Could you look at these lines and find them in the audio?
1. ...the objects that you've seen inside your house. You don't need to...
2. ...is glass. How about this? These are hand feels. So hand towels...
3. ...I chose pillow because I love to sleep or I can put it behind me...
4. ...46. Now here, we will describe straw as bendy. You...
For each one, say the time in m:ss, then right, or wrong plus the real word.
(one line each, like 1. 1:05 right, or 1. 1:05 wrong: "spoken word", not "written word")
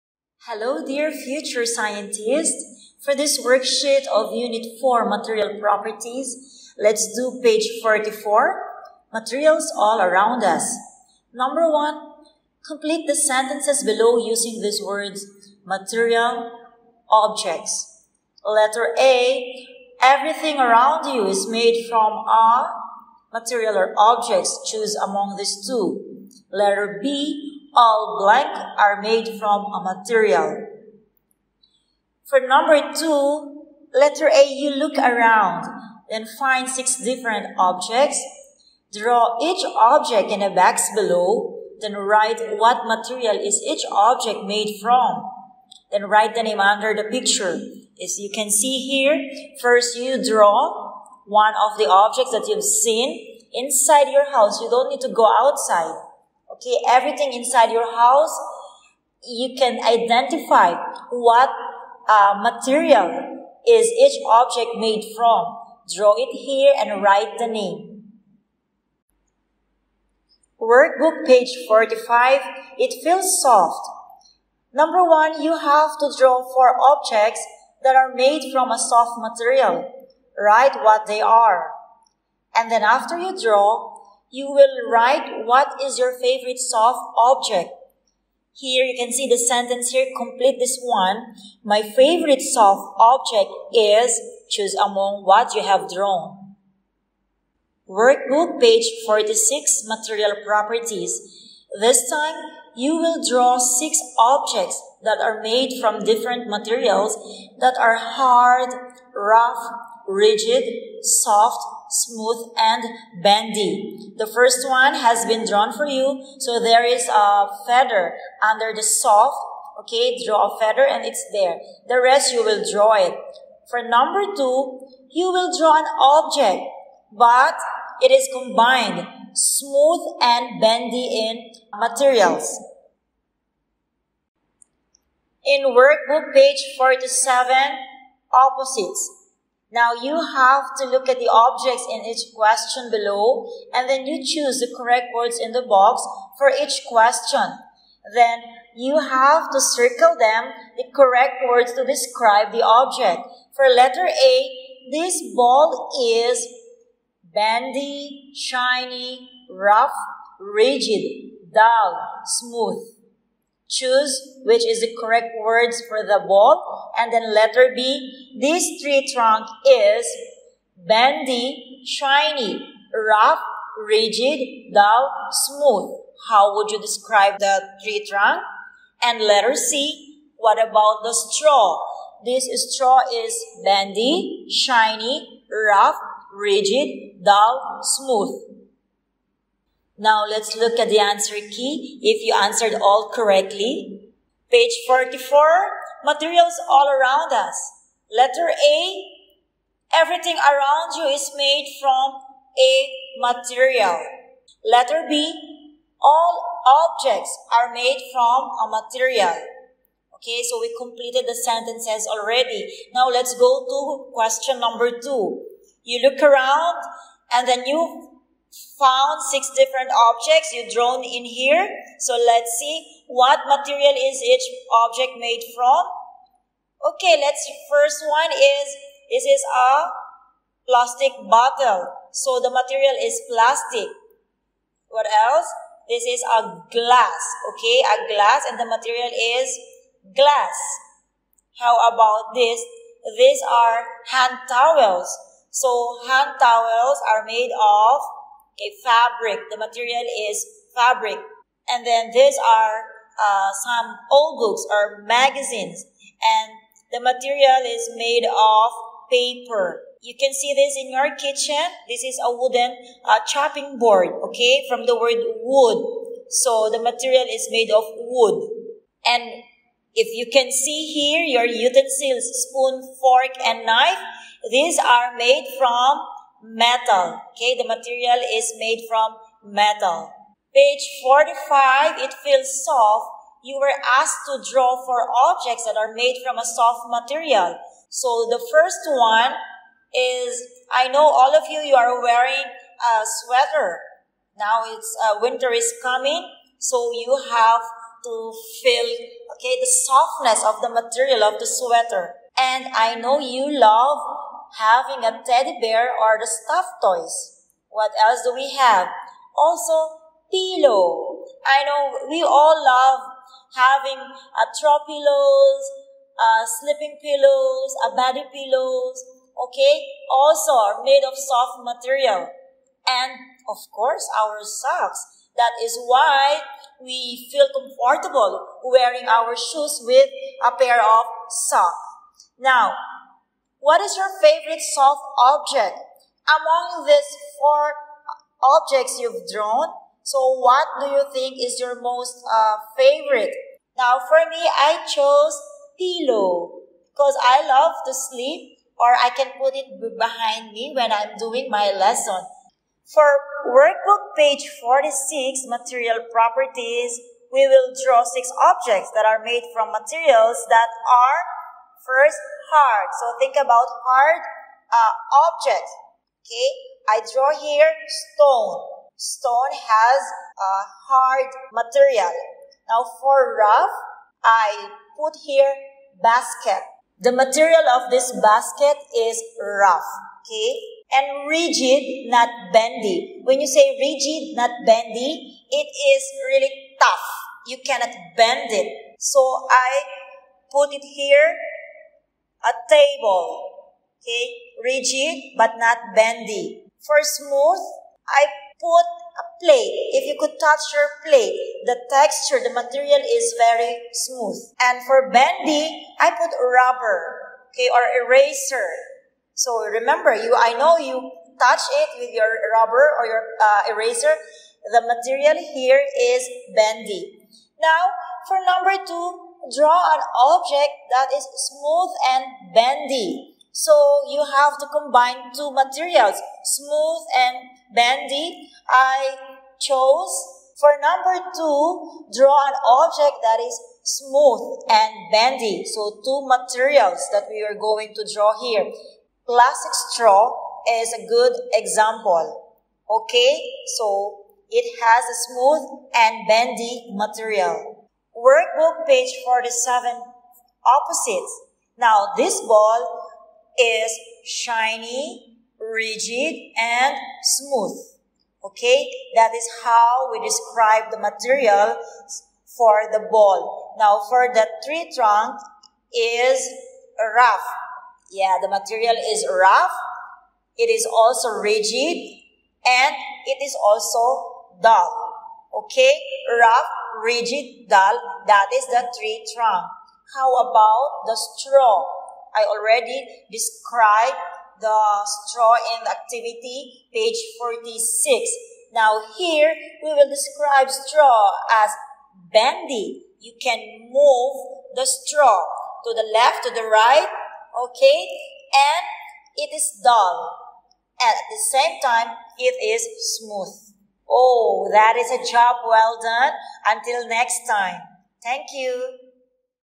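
1. 0:51 right
2. 3:59 wrong: "towels", not "feels"
3. 5:44 right
4. 8:07 right.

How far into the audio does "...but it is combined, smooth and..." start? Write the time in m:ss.
2:07.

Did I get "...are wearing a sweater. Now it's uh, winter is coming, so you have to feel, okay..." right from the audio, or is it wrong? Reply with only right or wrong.
right.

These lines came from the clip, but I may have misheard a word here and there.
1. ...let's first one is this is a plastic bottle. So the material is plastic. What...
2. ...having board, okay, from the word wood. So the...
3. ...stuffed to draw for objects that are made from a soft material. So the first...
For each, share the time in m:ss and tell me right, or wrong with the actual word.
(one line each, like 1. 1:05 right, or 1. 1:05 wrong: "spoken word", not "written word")
1. 3:47 right
2. 4:23 wrong: "chopping", not "having"
3. 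4:43 wrong: "asked", not "stuffed".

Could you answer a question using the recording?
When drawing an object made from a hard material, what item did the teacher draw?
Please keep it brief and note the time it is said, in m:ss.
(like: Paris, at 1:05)
stone, at 6:06.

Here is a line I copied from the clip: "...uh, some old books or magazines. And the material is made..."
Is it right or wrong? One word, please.
right.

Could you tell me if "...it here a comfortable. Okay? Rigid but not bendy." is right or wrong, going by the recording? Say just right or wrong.
wrong.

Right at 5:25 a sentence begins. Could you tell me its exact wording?
That is why we feel comfortable wearing our shoes with a pair of socks.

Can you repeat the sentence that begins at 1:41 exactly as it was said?
This time you will draw six objects that are made from different materials that are hard, rough, rigid, soft, smooth, and bendy.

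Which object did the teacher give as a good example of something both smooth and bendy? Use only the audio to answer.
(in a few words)
plastic straw.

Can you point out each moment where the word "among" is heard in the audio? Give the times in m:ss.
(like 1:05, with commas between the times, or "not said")
0:24, 1:34, 5:36.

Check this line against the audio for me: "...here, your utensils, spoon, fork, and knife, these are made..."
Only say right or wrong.
right.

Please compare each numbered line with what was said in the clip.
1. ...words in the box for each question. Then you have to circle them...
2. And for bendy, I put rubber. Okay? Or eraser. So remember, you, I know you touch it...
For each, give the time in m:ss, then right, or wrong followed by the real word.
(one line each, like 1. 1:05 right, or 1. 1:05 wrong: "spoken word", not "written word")
1. 2:25 right
2. 6:44 right.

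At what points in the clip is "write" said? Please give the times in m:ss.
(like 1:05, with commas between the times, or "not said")
0:41, 0:46, 1:07, 1:20, 1:24.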